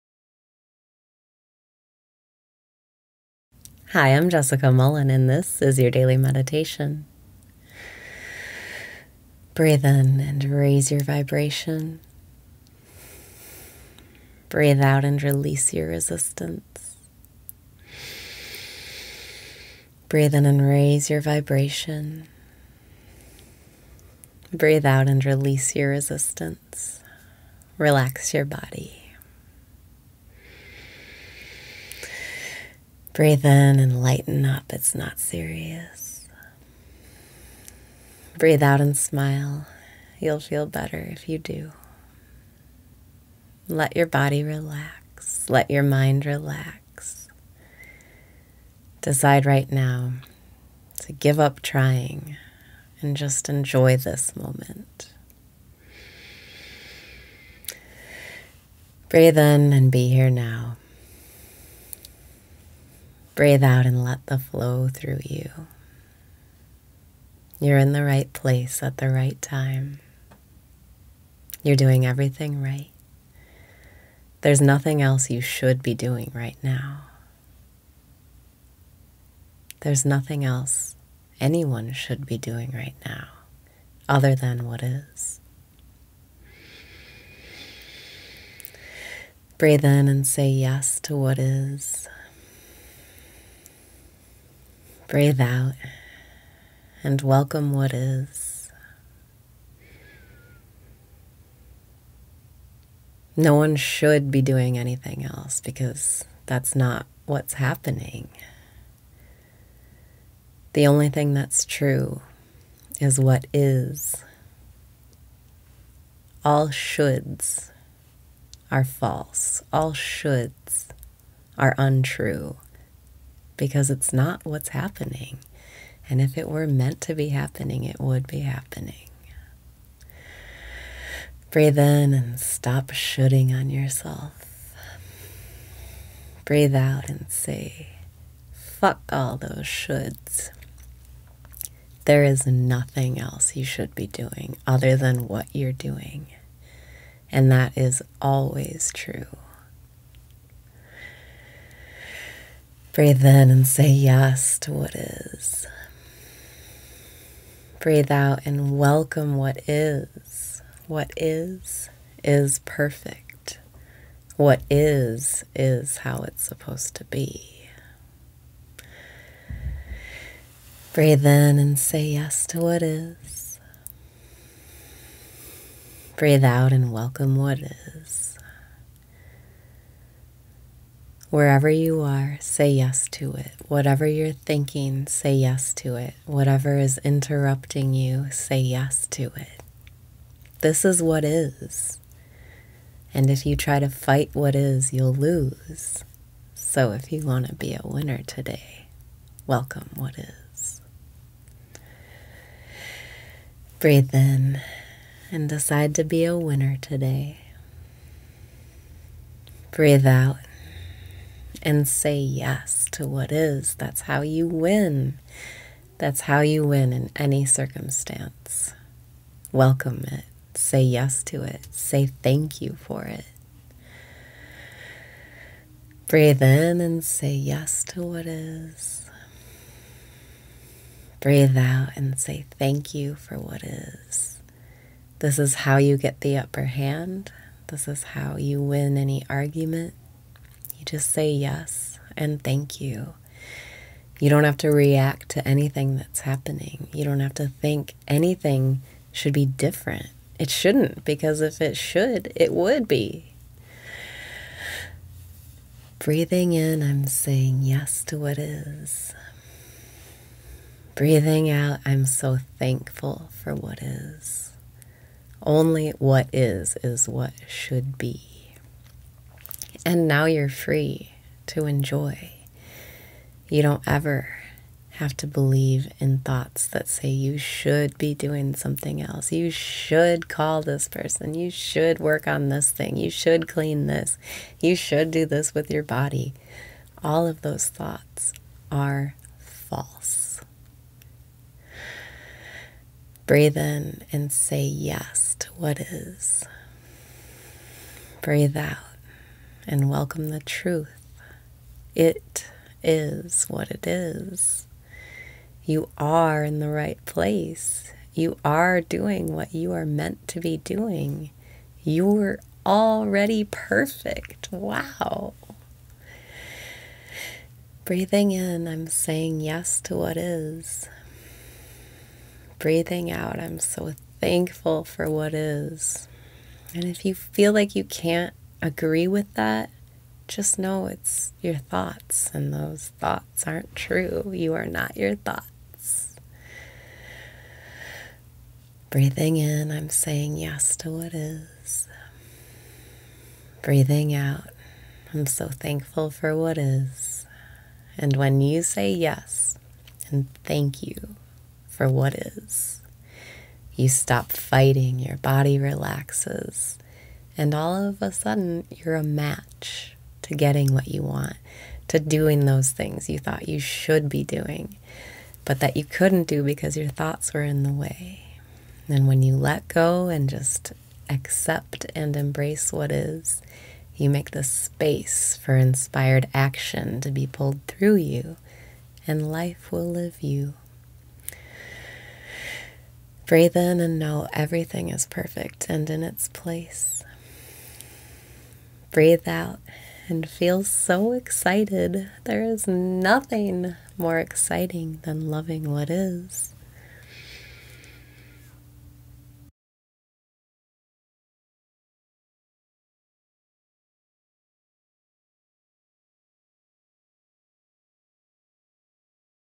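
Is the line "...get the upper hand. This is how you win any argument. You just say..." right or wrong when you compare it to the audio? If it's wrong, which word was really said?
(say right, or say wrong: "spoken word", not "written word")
right.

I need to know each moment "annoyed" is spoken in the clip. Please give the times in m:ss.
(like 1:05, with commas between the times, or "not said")
not said.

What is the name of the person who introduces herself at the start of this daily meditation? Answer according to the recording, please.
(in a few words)
Jessica Mullen.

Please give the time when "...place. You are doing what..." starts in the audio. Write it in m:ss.
5:07.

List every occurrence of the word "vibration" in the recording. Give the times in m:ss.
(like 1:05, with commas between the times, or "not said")
0:11, 0:21.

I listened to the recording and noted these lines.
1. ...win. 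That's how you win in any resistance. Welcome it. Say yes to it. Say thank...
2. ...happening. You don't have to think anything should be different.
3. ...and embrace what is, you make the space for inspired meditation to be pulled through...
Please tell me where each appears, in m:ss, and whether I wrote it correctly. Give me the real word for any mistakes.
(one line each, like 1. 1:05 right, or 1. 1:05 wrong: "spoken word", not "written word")
1. 3:34 wrong: "circumstance", not "resistance"
2. 4:06 right
3. 6:11 wrong: "action", not "meditation".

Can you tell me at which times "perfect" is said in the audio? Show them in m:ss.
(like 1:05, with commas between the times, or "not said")
2:42, 5:13, 6:25.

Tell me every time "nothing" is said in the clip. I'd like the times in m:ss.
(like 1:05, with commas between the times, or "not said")
1:14, 1:20, 2:22, 6:32.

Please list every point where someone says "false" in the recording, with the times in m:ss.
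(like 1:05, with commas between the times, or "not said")
1:58, 4:49.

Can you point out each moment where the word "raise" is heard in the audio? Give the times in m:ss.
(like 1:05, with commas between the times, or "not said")
0:10, 0:20.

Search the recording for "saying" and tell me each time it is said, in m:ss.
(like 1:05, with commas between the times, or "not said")
4:17, 5:18, 5:39.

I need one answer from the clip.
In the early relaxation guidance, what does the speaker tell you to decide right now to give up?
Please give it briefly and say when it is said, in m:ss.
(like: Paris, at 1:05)
trying, at 0:51.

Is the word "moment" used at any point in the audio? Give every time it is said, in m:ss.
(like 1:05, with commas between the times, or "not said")
0:54.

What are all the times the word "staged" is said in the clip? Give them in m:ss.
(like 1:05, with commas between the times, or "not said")
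not said.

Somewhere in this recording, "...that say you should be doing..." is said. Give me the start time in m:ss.
4:36.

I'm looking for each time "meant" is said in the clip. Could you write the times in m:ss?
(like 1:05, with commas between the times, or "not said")
2:06, 5:09.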